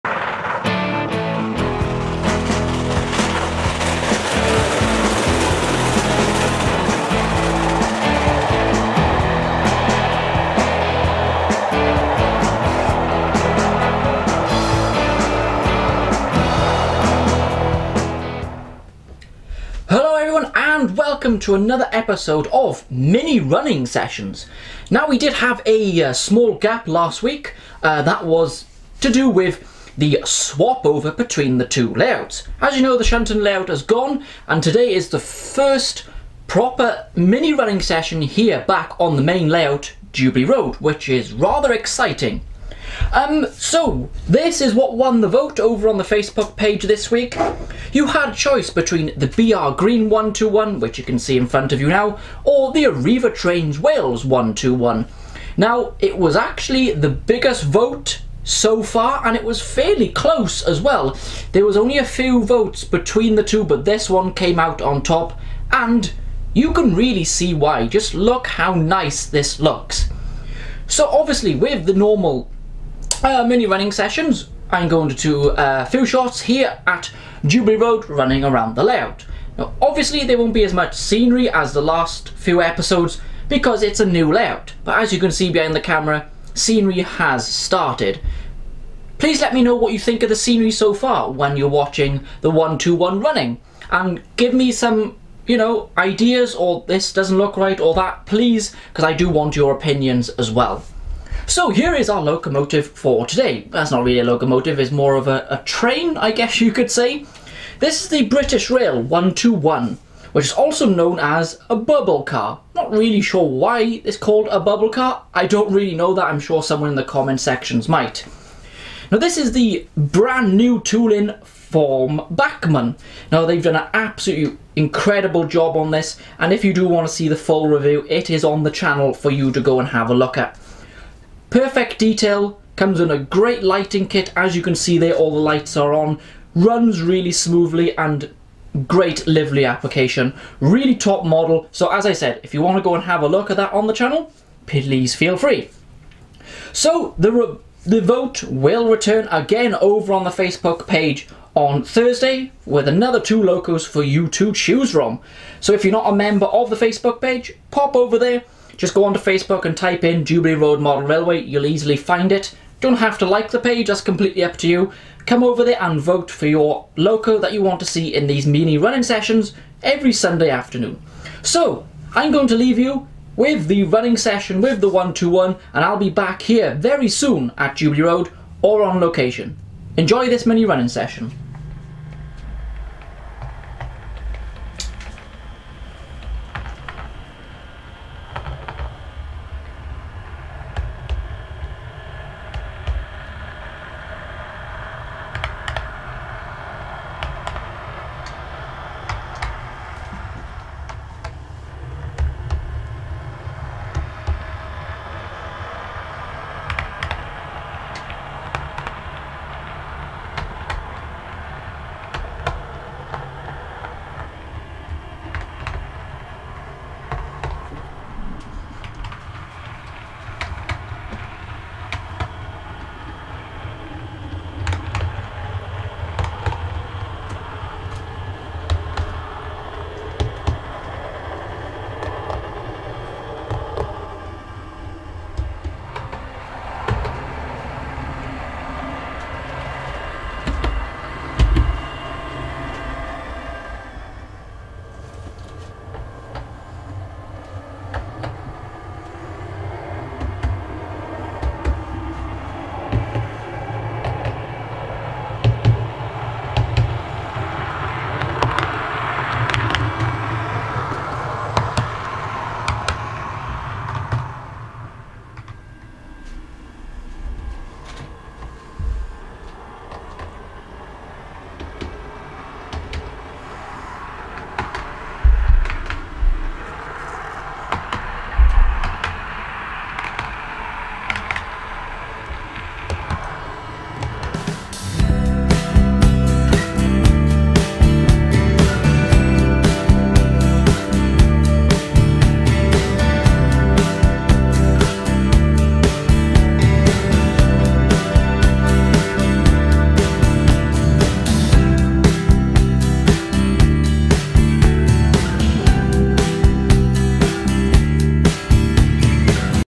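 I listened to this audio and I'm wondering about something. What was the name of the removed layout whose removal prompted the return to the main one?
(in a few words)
Shunton.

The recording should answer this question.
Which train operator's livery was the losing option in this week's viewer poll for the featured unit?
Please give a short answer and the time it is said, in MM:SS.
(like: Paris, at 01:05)
Arriva Trains Wales, at 00:52.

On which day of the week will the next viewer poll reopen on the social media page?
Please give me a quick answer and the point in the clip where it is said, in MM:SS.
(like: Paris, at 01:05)
Thursday, at 02:31.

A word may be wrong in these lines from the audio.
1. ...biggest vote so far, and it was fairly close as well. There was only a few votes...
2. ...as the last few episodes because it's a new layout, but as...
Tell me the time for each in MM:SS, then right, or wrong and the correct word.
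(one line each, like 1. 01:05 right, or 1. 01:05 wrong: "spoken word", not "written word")
1. 00:57 right
2. 01:21 right.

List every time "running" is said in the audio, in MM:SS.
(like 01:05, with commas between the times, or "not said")
00:23, 00:37, 01:13, 01:18, 01:33, 02:48, 02:53, 03:00.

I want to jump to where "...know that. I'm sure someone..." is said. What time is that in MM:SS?
01:55.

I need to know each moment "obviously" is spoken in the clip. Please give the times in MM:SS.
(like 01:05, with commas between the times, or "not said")
01:11, 01:19.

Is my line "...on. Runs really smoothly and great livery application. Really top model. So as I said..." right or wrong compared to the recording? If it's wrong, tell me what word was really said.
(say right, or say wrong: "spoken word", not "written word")
right.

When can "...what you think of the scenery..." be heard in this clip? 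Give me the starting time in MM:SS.
01:29.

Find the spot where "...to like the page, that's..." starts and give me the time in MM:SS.
02:43.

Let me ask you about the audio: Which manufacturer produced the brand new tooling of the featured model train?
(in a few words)
Bachmann.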